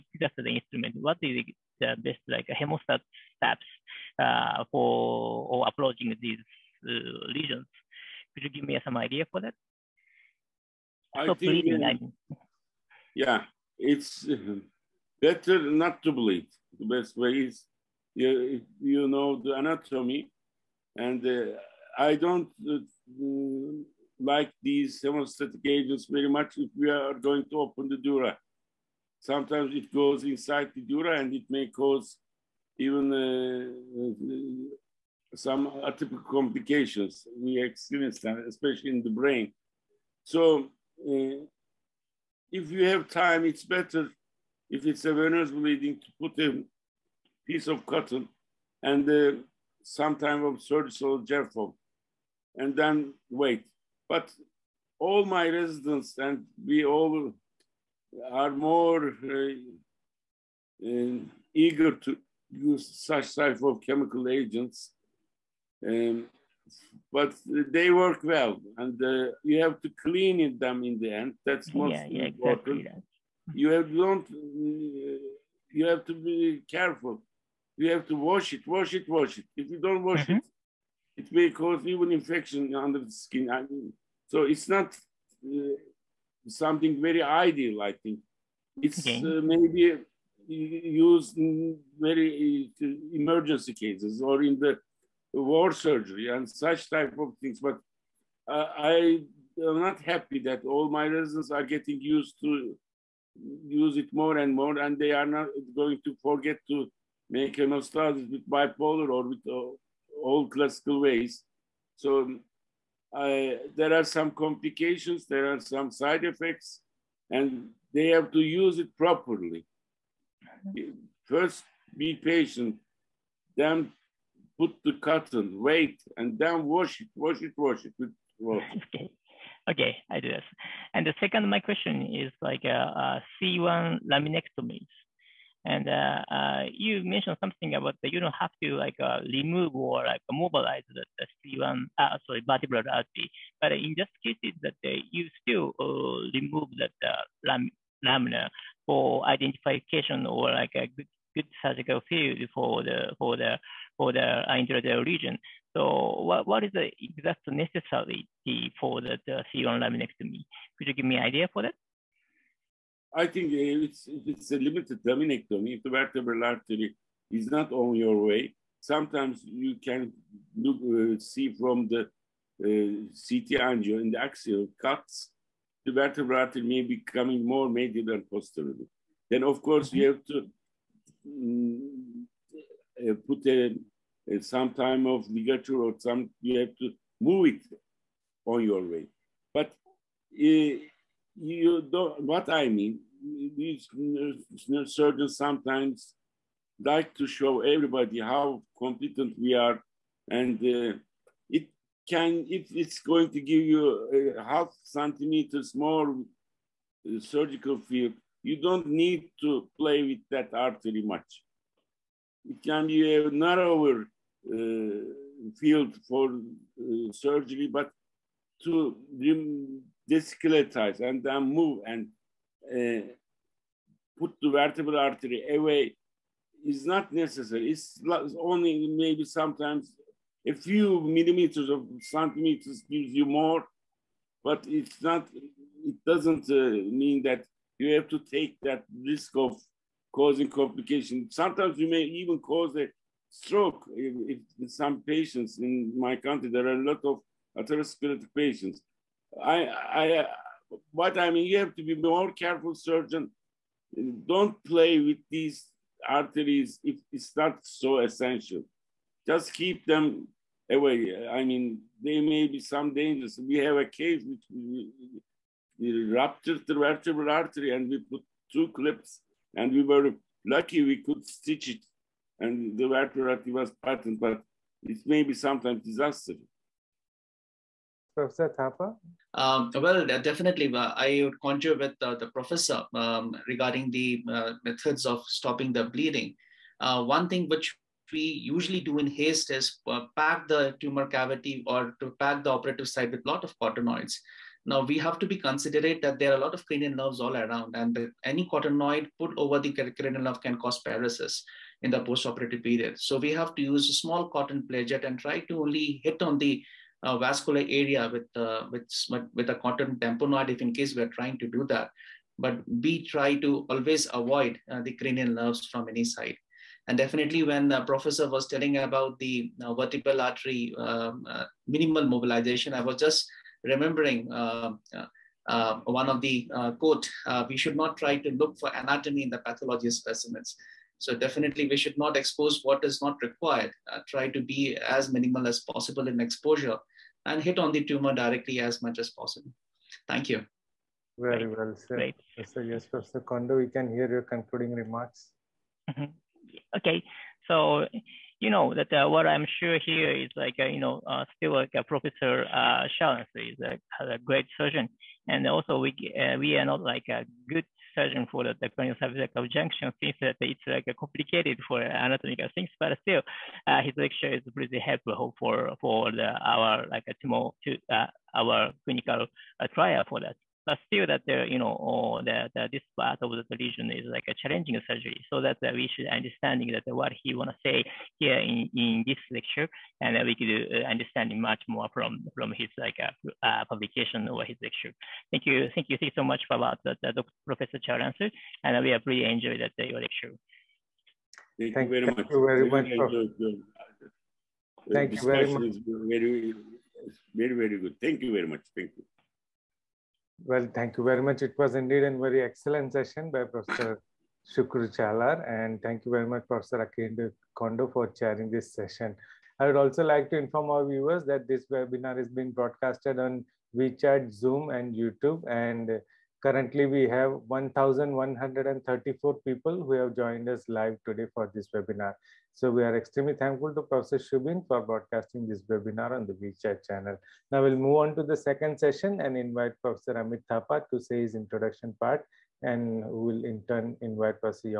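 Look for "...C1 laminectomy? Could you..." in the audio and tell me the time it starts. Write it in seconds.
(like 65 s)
159 s.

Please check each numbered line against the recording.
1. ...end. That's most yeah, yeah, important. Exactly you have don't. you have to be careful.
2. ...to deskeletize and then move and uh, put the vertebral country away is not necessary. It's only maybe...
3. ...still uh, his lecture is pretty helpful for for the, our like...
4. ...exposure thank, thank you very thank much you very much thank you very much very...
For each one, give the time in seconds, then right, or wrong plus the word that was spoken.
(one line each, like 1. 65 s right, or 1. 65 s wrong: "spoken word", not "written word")
1. 71 s right
2. 218 s wrong: "artery", not "country"
3. 363 s right
4. 390 s wrong: "lecture", not "exposure".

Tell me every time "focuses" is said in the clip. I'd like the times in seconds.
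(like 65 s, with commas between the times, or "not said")
not said.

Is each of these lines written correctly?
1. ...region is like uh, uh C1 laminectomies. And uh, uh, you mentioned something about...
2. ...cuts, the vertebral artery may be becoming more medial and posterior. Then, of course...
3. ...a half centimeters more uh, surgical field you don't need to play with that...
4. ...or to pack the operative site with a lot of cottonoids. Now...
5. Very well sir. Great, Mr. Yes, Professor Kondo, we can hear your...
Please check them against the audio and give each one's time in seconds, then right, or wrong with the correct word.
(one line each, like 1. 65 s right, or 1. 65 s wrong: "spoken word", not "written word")
1. 131 s wrong: "question", not "region"
2. 174 s right
3. 204 s right
4. 291 s right
5. 341 s right.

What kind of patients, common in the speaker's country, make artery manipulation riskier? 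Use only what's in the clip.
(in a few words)
atherosclerotic patients.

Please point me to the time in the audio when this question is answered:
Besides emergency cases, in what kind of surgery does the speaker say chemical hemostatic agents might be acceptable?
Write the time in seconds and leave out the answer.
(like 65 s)
95 s.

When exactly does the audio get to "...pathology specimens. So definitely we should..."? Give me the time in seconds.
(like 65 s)
329 s.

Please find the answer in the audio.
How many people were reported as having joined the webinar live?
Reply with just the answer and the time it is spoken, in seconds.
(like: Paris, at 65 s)
1,134, at 417 s.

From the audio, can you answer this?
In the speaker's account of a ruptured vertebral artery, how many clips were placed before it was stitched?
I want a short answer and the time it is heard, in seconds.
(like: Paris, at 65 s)
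2, at 268 s.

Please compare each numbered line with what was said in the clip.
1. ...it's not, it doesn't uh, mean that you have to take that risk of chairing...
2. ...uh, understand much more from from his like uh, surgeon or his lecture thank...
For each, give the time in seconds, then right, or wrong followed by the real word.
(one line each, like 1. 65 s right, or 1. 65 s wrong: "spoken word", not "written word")
1. 234 s wrong: "causing", not "chairing"
2. 380 s wrong: "publication", not "surgeon".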